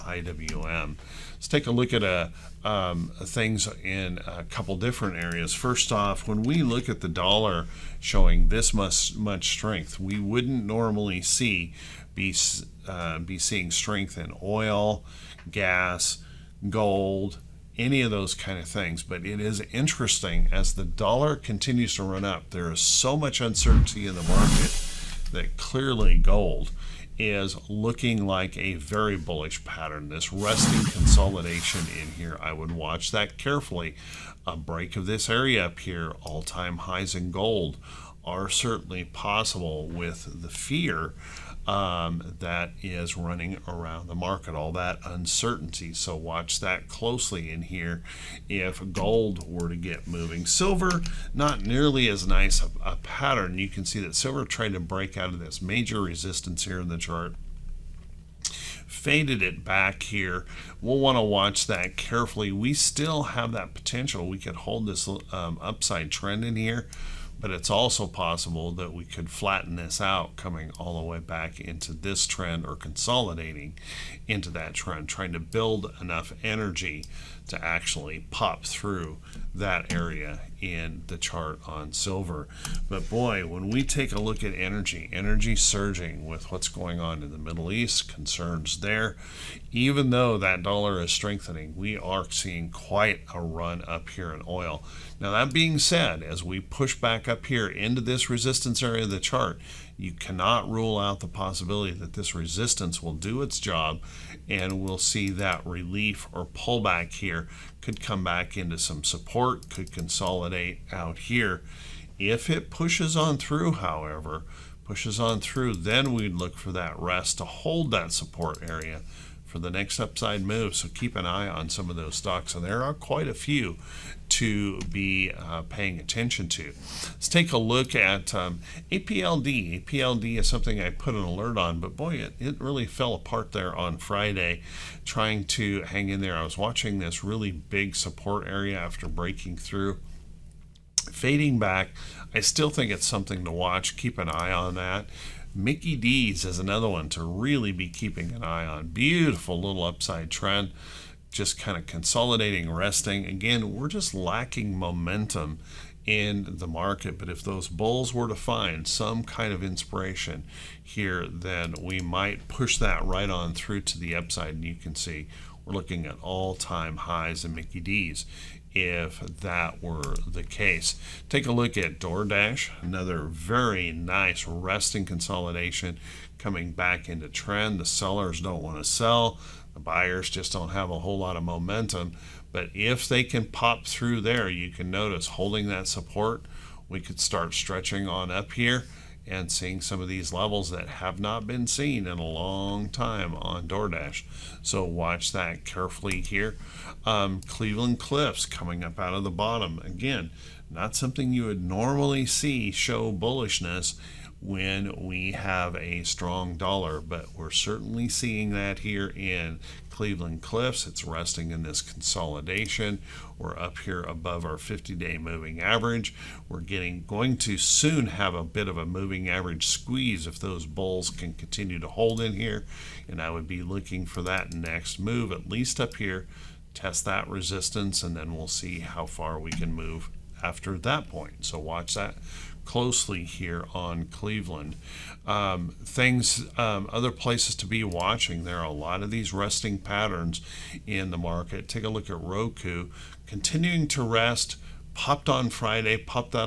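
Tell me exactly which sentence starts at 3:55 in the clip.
Um, things, um, other places to be watching.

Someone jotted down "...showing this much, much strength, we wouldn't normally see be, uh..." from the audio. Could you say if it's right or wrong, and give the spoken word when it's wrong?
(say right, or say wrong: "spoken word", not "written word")
right.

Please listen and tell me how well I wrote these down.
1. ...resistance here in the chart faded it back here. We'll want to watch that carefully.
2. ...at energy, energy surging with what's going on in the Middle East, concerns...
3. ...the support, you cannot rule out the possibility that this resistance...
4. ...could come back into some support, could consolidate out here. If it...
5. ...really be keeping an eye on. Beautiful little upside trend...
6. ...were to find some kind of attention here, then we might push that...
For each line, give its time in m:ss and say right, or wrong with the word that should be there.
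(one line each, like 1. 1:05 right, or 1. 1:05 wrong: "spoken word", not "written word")
1. 0:56 right
2. 1:24 right
3. 1:39 wrong: "chart", not "support"
4. 1:47 right
5. 2:27 right
6. 2:38 wrong: "inspiration", not "attention".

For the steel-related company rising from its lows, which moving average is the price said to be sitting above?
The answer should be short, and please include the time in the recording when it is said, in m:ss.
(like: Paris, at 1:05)
50-day moving average, at 3:34.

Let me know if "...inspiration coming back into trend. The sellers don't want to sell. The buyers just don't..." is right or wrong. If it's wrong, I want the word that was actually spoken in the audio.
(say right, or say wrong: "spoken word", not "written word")
wrong: "consolidation", not "inspiration".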